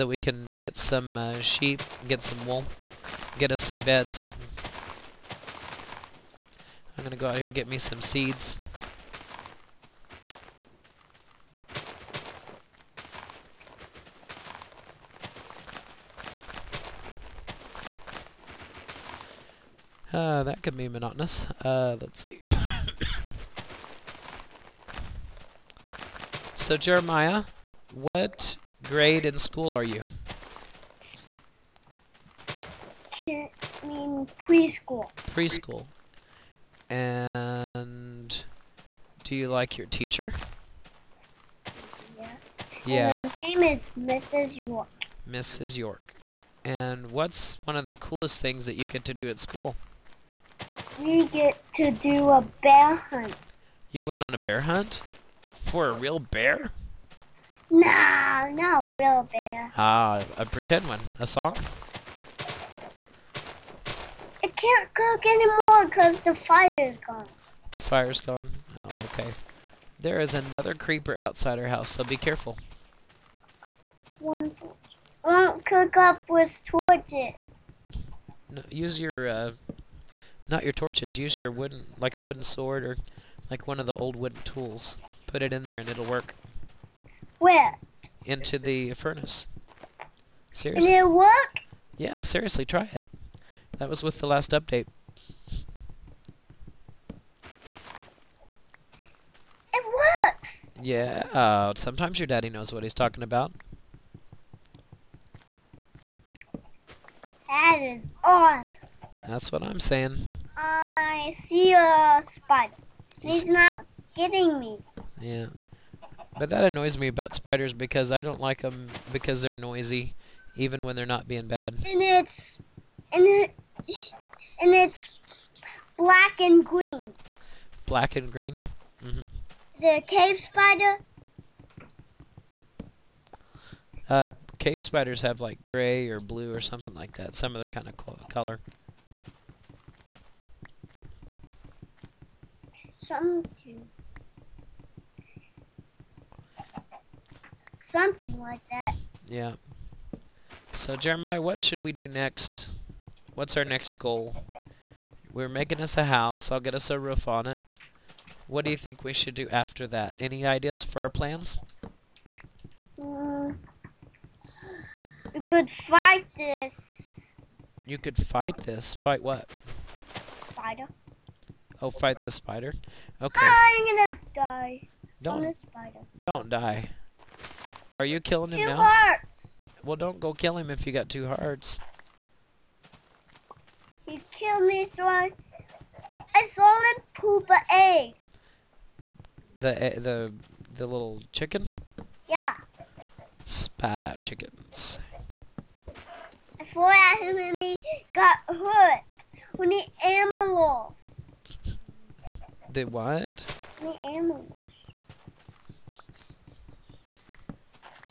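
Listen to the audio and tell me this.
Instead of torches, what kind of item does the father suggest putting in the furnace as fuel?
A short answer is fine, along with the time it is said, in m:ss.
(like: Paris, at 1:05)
Wooden sword, at 1:22.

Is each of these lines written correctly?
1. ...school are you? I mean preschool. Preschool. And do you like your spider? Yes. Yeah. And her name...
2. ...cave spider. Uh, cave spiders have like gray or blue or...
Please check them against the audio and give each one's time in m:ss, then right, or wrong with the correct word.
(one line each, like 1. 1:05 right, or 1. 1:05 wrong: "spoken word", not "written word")
1. 0:29 wrong: "teacher", not "spider"
2. 2:10 right.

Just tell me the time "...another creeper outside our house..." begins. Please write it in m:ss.
1:10.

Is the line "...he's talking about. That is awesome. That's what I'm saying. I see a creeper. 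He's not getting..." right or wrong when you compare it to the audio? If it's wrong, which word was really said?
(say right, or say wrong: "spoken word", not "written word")
wrong: "spider", not "creeper".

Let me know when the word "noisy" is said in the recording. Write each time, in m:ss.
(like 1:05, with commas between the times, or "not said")
1:59.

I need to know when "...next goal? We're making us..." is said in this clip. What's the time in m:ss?
2:33.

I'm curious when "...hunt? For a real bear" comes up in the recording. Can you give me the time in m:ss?
0:54.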